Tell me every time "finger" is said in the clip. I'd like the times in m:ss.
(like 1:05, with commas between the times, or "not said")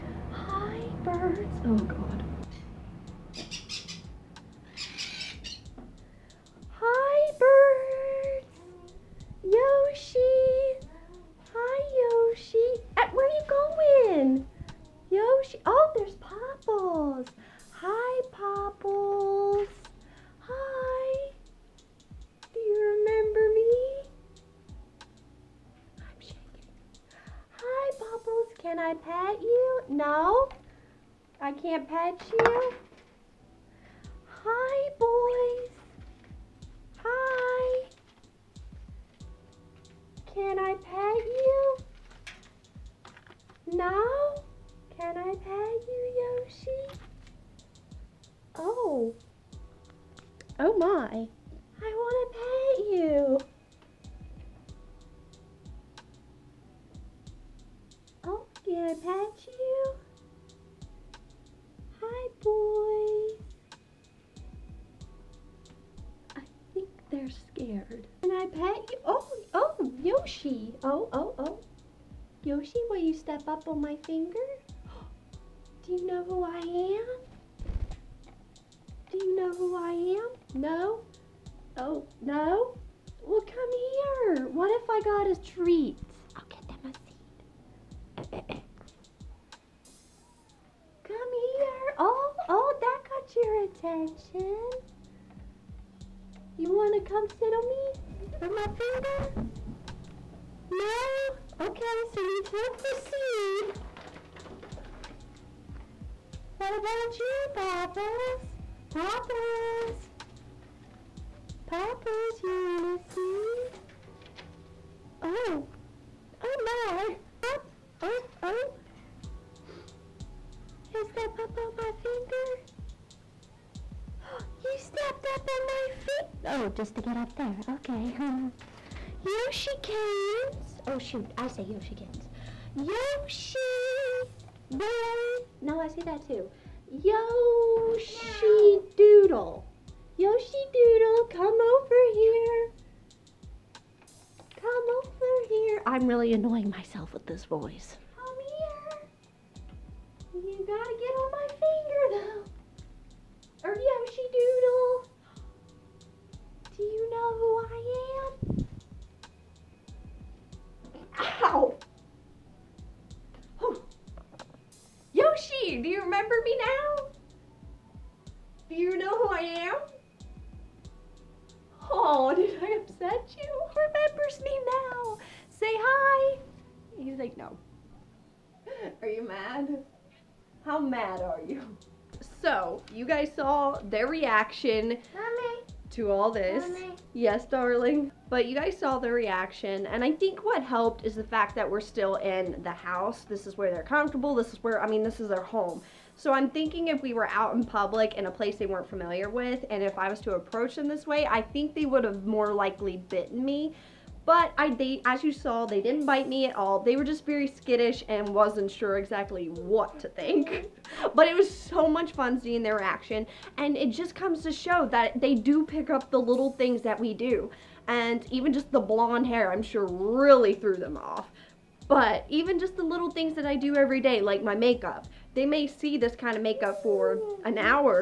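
1:14, 1:38, 2:02.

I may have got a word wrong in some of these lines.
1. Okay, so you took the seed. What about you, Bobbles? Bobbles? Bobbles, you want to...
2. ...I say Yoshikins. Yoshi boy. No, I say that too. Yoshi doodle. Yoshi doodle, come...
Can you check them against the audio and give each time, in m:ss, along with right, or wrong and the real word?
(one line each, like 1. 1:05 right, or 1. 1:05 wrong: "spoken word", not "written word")
1. 1:41 right
2. 2:11 right.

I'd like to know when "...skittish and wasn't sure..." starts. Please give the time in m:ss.
3:27.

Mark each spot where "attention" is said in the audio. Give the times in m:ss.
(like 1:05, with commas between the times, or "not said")
1:33.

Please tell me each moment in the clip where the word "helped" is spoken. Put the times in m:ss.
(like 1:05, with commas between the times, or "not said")
3:10.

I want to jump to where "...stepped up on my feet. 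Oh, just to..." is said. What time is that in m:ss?
2:04.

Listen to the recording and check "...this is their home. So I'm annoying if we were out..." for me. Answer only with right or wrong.
wrong.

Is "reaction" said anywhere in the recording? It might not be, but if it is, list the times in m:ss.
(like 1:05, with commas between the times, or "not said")
3:04, 3:09, 3:32.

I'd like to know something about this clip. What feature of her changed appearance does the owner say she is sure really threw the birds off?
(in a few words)
blonde hair.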